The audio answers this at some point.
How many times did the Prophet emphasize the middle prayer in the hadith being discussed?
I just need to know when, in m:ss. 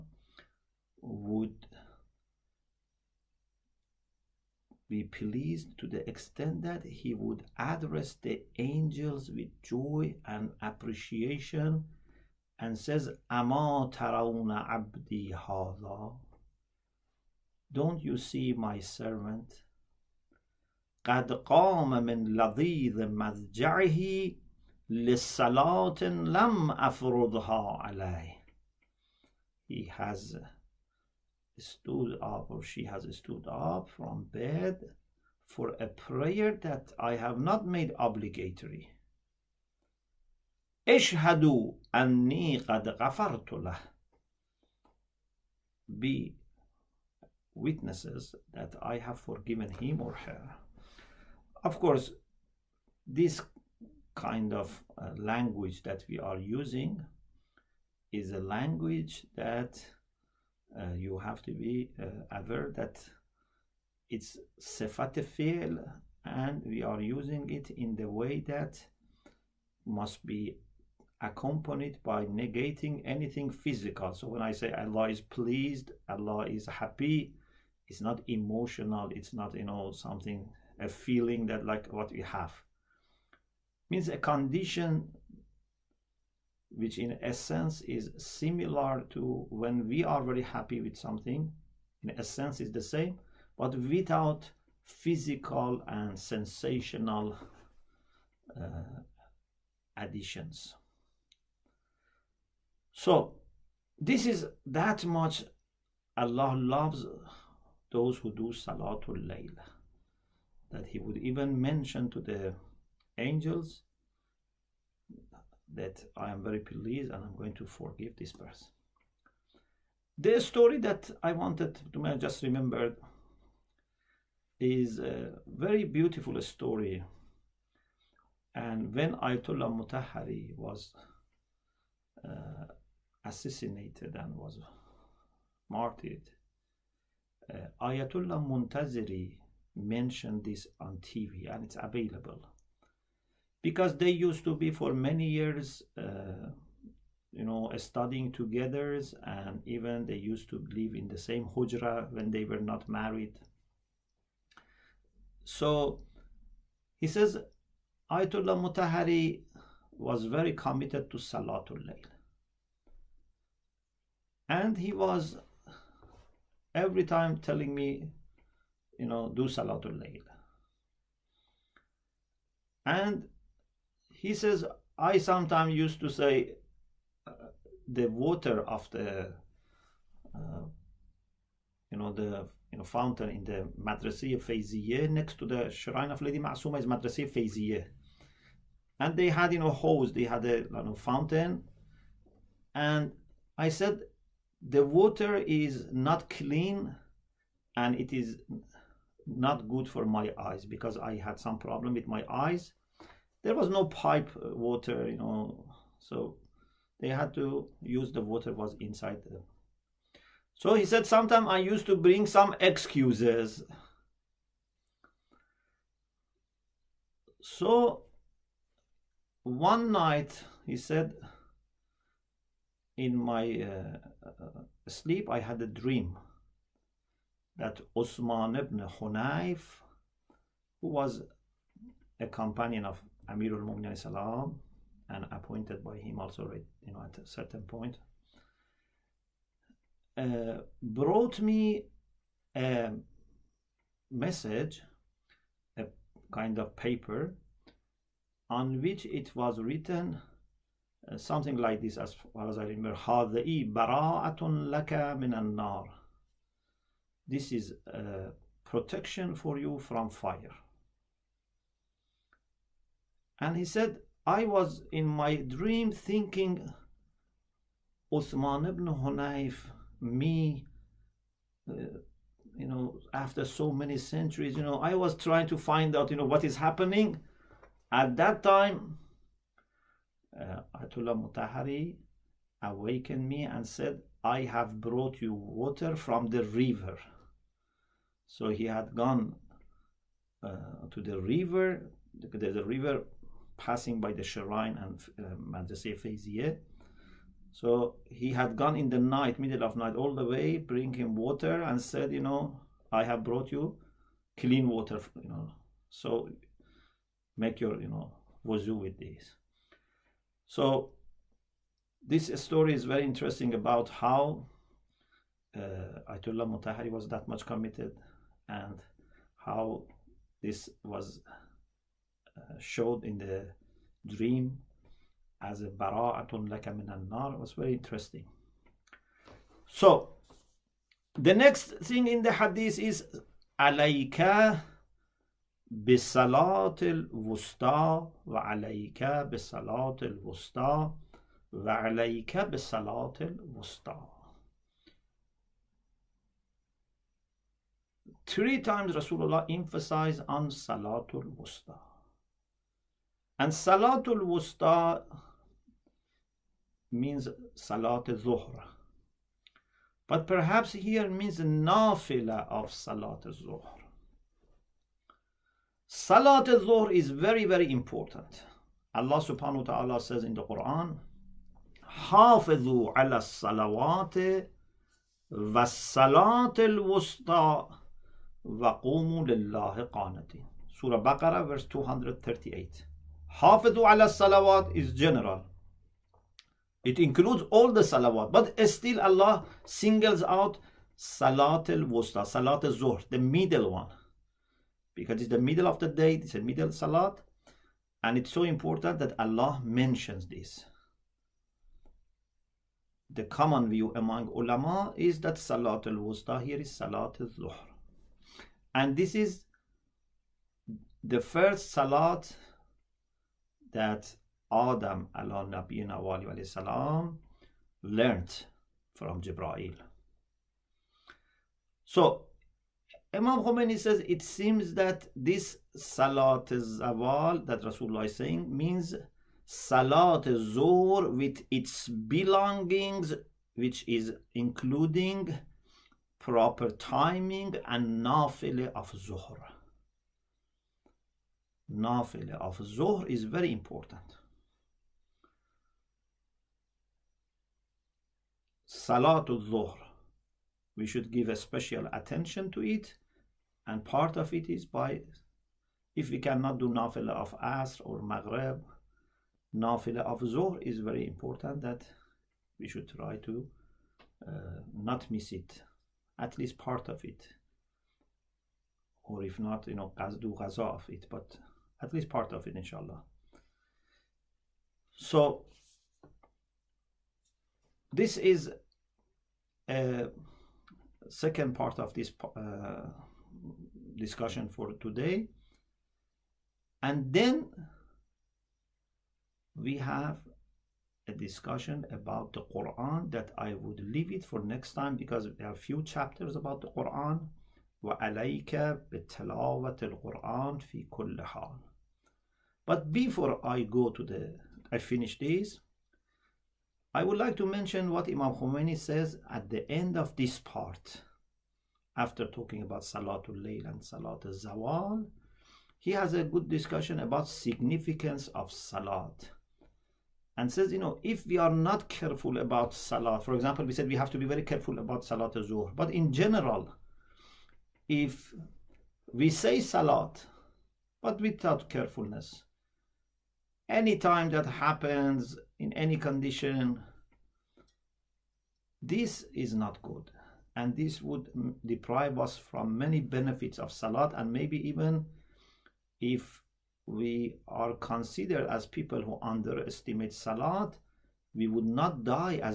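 5:48.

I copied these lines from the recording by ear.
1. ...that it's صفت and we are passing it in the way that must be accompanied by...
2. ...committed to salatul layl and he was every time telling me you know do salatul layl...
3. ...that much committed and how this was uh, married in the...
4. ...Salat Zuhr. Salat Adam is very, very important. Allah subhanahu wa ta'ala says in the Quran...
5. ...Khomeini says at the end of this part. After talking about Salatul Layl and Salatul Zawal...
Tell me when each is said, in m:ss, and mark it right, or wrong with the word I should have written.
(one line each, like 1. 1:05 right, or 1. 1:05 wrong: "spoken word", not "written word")
1. 1:02 wrong: "using", not "passing"
2. 2:40 right
3. 5:17 wrong: "showed", not "married"
4. 6:02 wrong: "Zuhr", not "Adam"
5. 8:28 right.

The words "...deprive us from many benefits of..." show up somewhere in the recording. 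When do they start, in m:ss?
9:01.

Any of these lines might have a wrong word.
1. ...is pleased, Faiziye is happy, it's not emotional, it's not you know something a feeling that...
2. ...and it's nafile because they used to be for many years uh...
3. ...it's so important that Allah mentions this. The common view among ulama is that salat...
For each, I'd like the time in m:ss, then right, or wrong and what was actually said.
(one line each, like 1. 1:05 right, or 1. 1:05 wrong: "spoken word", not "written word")
1. 1:15 wrong: "Allah", not "Faiziye"
2. 2:21 wrong: "available", not "nafile"
3. 6:38 right.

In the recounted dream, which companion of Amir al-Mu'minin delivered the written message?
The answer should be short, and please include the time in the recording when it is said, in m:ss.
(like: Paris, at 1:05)
Uthman ibn Hunayf, at 3:47.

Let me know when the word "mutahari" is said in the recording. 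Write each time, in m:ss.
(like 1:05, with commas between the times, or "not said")
2:09, 2:38, 4:41, 5:16.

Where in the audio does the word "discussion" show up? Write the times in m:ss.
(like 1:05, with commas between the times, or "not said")
8:03, 8:11, 8:36.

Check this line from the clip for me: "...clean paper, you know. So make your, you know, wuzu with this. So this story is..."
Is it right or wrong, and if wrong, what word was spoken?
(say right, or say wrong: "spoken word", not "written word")
wrong: "water", not "paper".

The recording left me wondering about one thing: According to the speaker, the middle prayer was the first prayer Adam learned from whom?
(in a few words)
Jibrail.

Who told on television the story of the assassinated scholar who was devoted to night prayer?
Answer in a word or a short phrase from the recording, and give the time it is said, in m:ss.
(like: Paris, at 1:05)
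Ayatollah Muntaziri, at 2:17.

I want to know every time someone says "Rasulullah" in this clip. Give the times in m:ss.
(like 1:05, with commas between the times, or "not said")
5:48, 7:07.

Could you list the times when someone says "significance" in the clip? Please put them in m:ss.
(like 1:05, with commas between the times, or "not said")
8:37.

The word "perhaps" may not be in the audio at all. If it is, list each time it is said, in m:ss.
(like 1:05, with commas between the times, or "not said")
6:00.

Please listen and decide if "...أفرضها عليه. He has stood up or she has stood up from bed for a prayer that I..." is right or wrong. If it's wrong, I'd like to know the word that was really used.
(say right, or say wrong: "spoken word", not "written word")
right.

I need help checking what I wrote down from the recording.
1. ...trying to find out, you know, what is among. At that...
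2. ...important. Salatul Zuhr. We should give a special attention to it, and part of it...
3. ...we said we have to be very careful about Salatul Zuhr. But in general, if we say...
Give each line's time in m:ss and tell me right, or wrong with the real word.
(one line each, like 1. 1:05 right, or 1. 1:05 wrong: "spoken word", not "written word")
1. 4:35 wrong: "happening", not "among"
2. 7:23 right
3. 8:43 right.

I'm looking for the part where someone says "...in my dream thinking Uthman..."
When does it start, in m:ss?
4:24.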